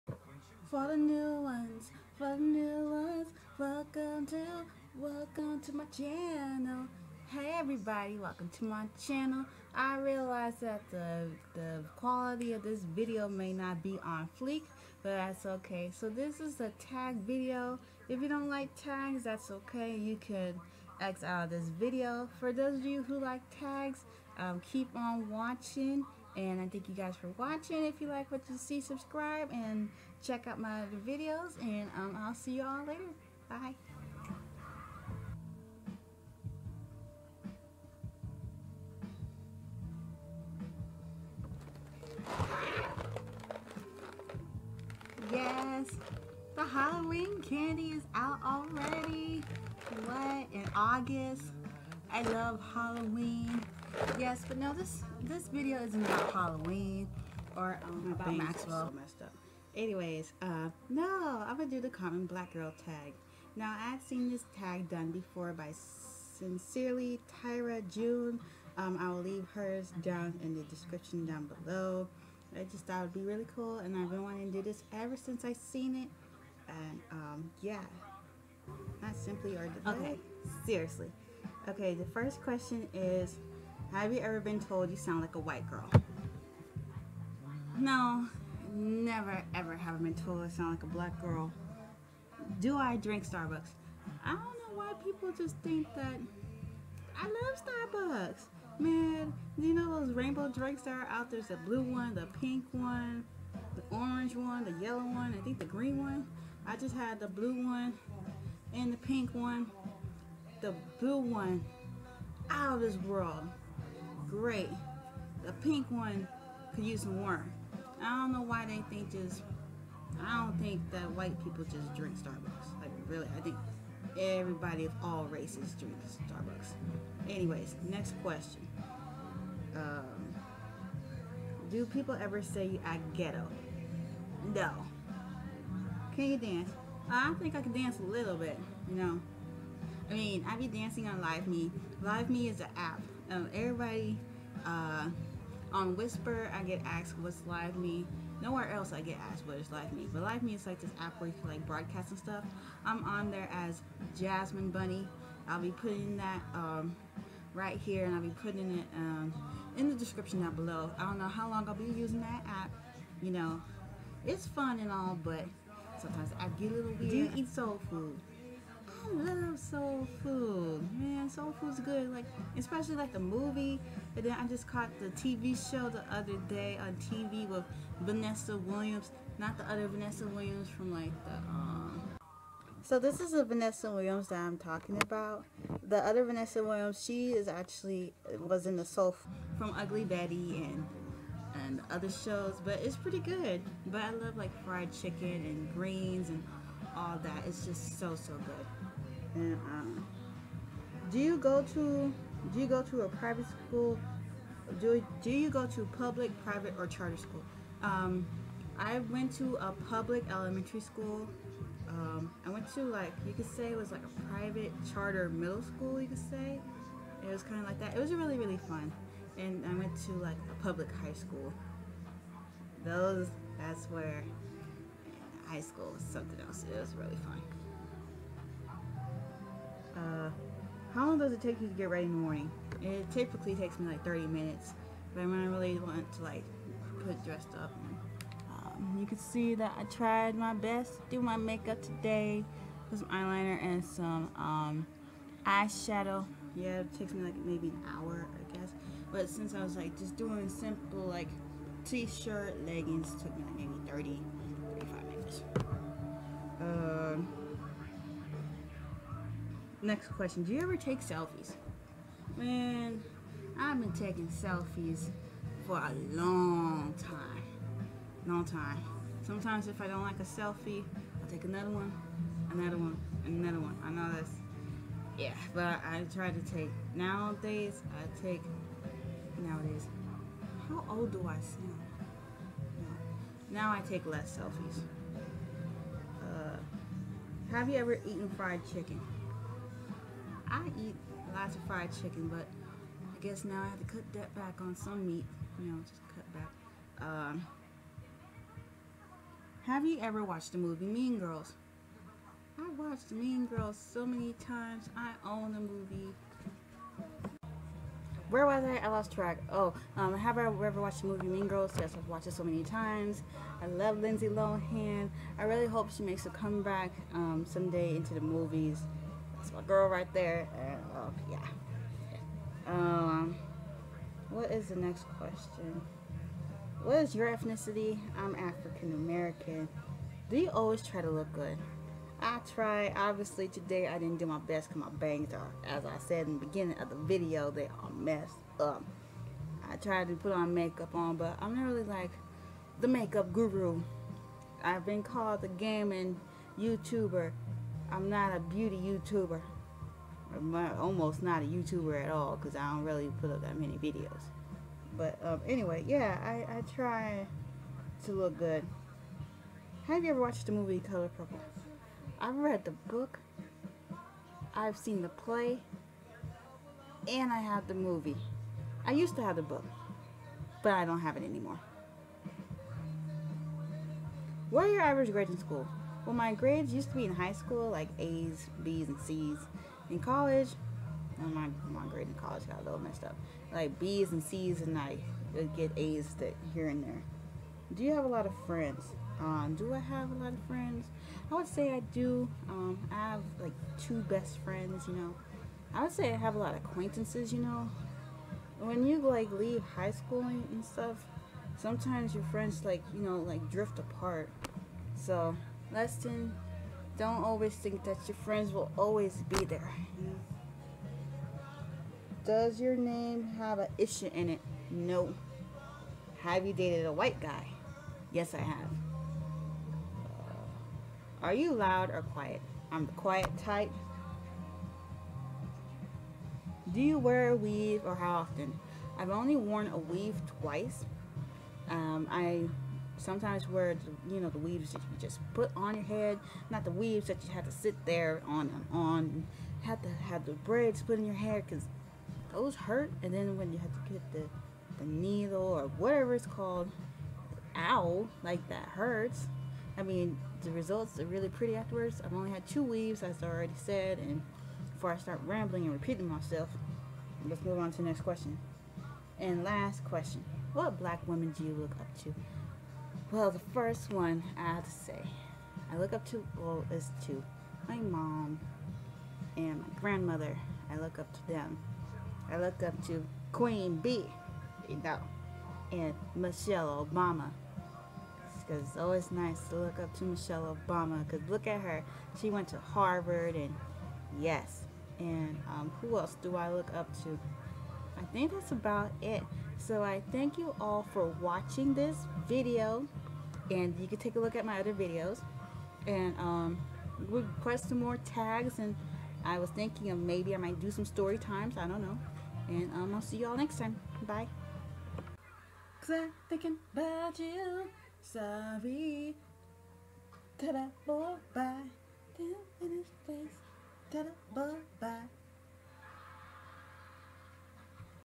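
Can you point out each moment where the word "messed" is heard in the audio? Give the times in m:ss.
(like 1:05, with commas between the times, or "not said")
5:37, 6:22.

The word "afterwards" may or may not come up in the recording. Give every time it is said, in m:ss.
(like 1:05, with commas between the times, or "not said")
7:31.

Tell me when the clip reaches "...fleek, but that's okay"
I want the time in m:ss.
0:14.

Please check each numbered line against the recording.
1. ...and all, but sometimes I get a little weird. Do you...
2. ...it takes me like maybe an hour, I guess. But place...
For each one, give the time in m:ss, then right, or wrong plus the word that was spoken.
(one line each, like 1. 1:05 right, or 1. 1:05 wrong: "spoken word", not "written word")
1. 2:44 right
2. 4:06 wrong: "since", not "place".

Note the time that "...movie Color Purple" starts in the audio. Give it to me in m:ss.
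6:00.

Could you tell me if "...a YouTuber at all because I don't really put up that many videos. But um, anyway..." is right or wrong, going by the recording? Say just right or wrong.
right.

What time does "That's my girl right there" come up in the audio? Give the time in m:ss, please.
5:19.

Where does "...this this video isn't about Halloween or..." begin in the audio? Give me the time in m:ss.
0:54.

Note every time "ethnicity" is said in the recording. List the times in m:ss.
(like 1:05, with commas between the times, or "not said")
5:27.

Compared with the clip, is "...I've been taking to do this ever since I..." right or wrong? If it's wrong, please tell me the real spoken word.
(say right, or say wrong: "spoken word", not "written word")
wrong: "wanting", not "taking".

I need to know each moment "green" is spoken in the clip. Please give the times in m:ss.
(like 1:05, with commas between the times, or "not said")
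1:45, 3:15.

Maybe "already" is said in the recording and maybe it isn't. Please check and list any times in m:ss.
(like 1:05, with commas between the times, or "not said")
0:48, 7:33.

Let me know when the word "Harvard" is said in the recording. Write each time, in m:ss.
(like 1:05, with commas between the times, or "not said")
8:02.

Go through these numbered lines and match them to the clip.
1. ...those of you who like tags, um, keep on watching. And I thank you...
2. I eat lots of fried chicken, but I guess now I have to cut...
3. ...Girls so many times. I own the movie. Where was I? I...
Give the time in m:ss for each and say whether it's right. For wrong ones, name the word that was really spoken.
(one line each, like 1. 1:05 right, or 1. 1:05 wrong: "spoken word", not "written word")
1. 0:22 right
2. 4:50 right
3. 5:03 right.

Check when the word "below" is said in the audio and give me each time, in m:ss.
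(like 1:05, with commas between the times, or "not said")
1:11, 2:40.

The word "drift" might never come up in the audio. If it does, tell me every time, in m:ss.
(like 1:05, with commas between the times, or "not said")
6:43.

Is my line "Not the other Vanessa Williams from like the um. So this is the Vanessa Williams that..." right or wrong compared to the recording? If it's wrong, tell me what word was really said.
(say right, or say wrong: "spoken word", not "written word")
right.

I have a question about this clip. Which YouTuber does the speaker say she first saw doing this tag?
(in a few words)
Sincerely Tyra June.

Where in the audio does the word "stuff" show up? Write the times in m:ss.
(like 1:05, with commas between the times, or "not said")
2:32, 6:40.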